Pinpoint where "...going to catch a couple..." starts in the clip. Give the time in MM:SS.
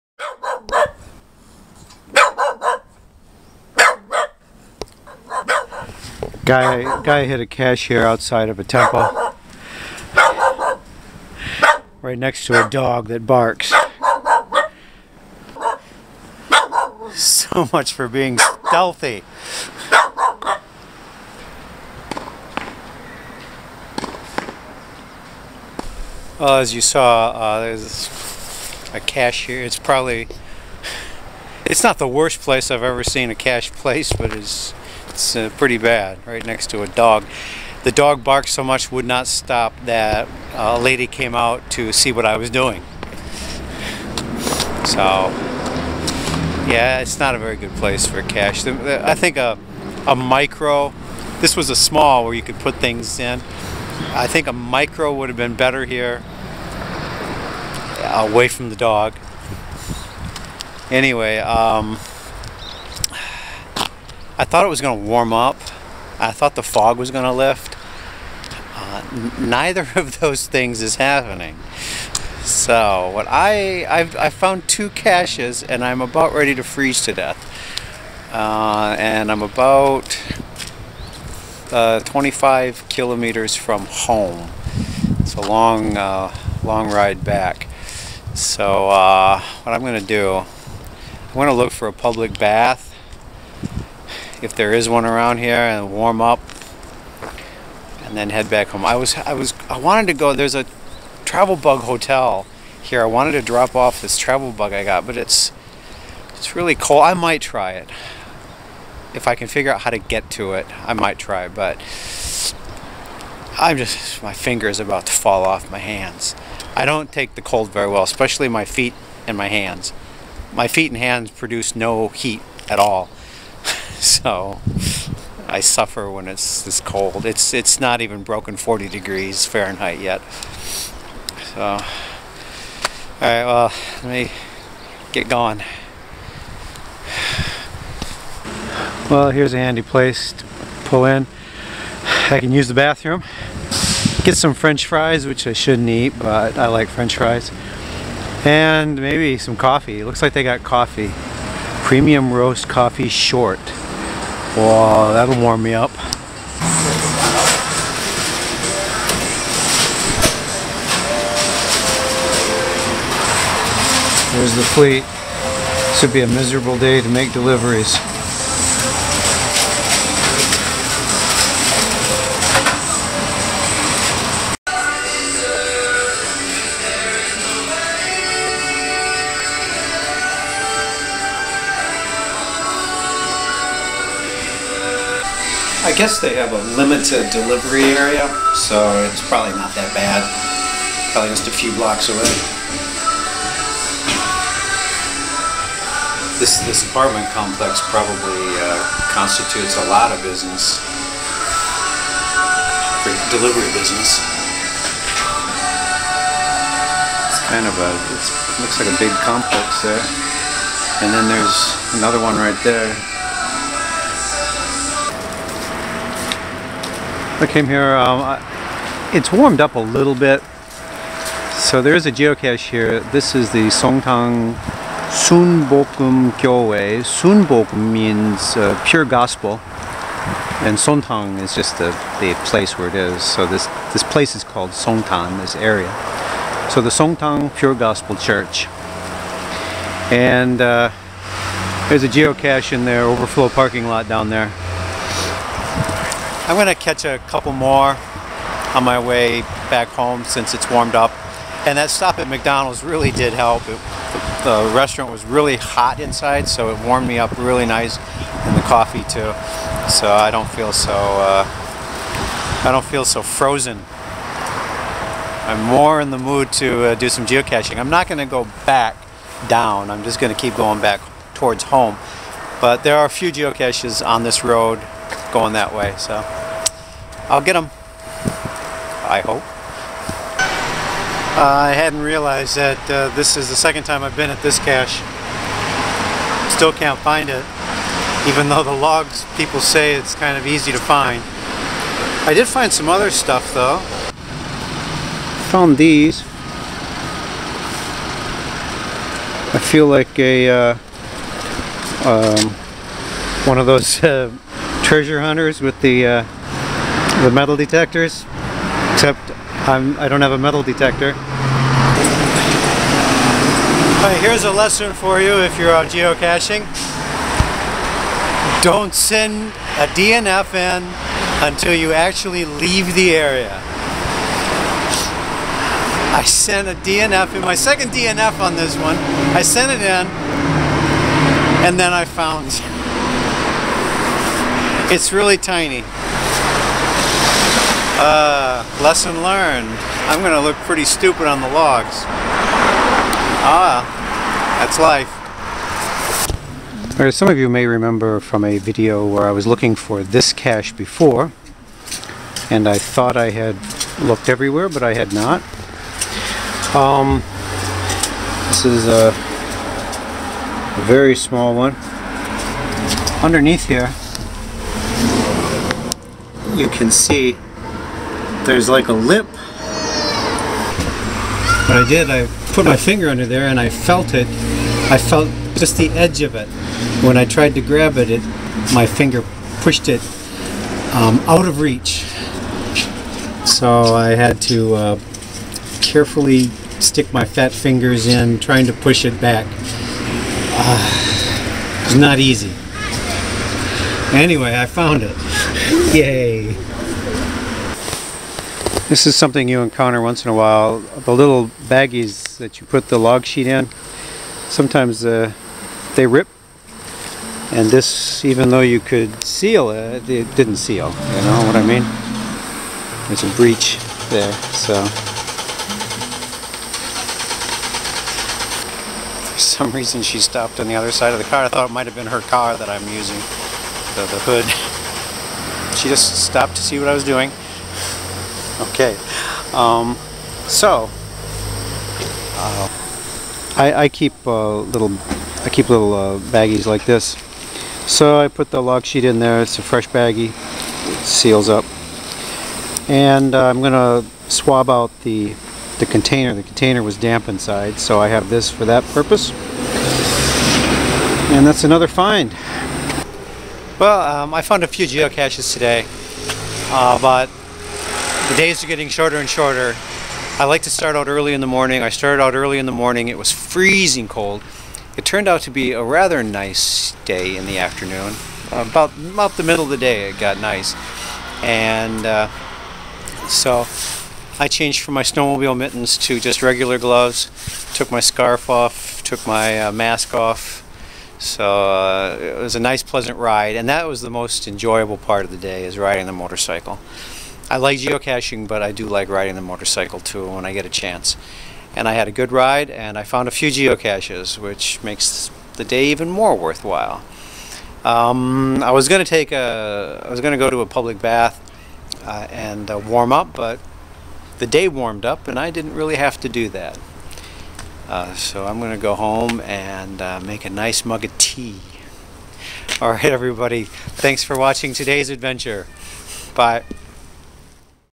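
04:06.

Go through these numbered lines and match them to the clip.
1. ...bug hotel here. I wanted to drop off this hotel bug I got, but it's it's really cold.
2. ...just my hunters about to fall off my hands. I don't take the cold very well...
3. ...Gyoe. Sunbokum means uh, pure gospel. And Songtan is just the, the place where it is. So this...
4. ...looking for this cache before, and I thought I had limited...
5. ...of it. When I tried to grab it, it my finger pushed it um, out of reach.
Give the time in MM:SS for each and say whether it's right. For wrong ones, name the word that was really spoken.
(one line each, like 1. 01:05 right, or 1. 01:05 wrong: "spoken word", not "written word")
1. 01:41 wrong: "travel", not "hotel"
2. 01:53 wrong: "fingers", not "hunters"
3. 03:46 right
4. 05:49 wrong: "looked", not "limited"
5. 06:16 right.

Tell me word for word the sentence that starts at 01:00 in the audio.
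Anyway, um, I thought it was going to warm up.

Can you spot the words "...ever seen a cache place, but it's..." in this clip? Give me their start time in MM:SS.
00:32.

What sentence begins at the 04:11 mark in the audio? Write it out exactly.
And that stop at McDonald's really did help.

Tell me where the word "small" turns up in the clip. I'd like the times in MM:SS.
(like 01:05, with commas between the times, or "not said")
00:51, 06:01.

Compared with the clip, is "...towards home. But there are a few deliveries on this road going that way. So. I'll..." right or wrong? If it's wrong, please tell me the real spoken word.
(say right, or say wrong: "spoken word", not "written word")
wrong: "geocaches", not "deliveries".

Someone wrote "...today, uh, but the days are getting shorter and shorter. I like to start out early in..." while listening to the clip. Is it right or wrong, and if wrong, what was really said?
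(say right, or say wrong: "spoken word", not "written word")
right.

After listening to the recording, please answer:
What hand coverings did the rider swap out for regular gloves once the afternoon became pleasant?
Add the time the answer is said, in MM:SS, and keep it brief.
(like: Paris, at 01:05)
Snowmobile mittens, at 07:55.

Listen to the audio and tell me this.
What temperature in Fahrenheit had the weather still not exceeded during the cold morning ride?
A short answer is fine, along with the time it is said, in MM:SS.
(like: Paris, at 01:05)
40 degrees, at 02:08.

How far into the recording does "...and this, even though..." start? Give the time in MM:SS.
06:47.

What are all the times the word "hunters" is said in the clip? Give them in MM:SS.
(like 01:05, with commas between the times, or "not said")
05:05.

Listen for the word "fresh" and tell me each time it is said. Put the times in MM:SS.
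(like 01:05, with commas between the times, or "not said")
07:19.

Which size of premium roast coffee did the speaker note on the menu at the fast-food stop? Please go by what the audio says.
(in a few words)
Short.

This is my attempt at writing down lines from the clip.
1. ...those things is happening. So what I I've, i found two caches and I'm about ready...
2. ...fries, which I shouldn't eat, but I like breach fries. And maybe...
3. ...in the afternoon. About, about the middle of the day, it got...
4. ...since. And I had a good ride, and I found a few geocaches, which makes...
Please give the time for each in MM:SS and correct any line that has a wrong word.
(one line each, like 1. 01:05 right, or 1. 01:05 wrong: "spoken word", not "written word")
1. 01:10 right
2. 02:24 wrong: "french", not "breach"
3. 07:47 right
4. 08:10 wrong: "chance", not "since".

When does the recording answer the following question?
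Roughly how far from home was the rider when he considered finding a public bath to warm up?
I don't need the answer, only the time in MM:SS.
01:21.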